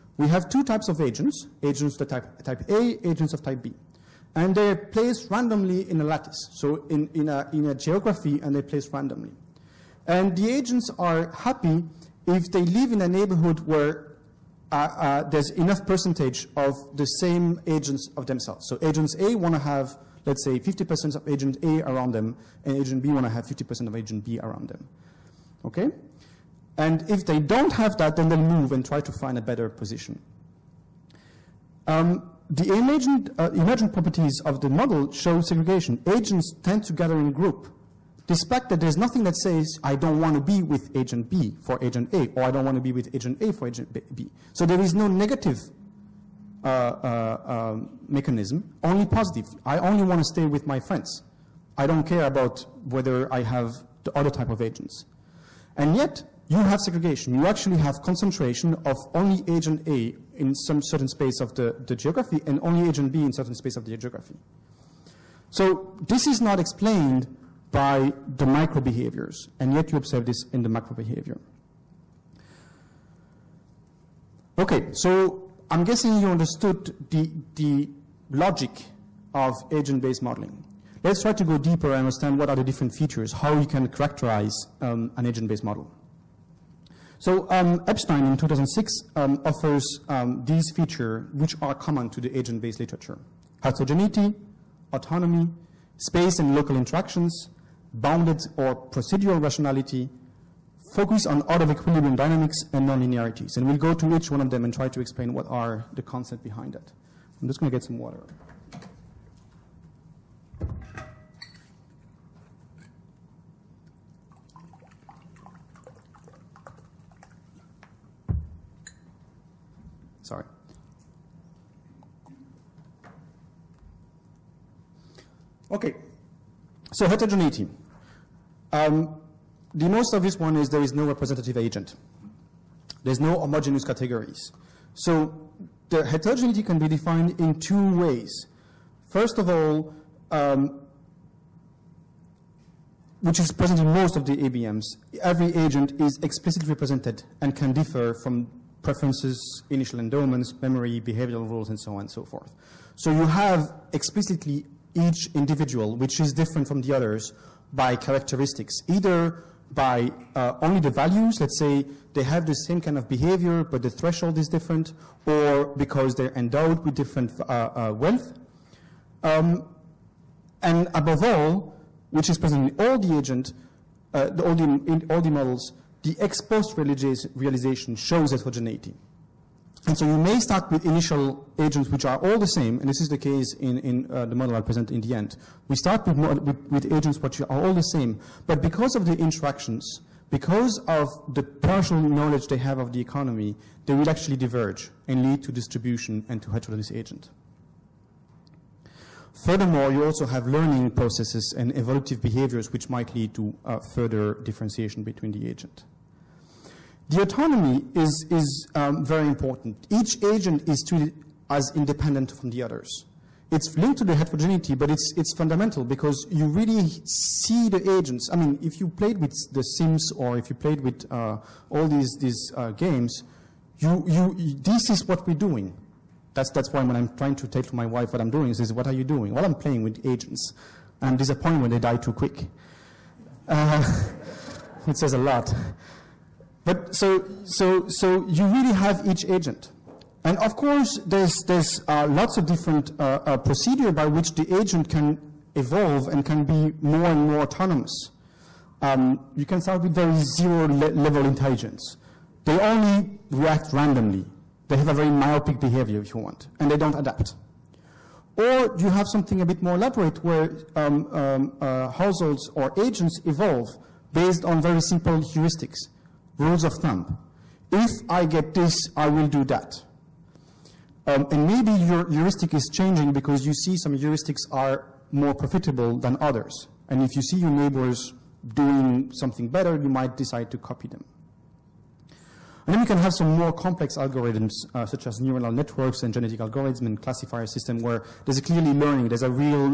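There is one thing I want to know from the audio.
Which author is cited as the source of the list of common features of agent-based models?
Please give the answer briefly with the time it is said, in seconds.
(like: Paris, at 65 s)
Epstein, at 87 s.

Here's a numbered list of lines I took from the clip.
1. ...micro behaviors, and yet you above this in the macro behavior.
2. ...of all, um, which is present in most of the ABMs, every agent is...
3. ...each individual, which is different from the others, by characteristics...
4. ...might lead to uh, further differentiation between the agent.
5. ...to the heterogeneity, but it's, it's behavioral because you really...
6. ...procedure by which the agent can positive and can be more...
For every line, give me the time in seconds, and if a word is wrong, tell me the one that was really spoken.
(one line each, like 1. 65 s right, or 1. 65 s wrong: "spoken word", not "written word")
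1. 68 s wrong: "observe", not "above"
2. 139 s right
3. 154 s right
4. 202 s right
5. 213 s wrong: "fundamental", not "behavioral"
6. 243 s wrong: "evolve", not "positive".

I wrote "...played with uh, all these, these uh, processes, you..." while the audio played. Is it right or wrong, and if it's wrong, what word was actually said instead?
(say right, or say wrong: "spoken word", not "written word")
wrong: "games", not "processes".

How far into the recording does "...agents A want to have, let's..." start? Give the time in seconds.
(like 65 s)
18 s.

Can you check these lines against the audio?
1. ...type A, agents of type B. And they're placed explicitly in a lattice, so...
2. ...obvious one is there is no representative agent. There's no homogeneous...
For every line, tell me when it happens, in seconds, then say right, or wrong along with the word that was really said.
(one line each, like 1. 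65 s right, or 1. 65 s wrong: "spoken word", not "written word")
1. 2 s wrong: "randomly", not "explicitly"
2. 130 s right.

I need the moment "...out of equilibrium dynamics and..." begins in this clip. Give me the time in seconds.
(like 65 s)
101 s.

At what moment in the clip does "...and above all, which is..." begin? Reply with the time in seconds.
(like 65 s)
170 s.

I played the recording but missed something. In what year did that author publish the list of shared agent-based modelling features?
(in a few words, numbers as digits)
2006.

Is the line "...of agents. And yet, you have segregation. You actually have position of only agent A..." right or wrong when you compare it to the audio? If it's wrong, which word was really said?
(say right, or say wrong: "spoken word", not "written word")
wrong: "concentration", not "position".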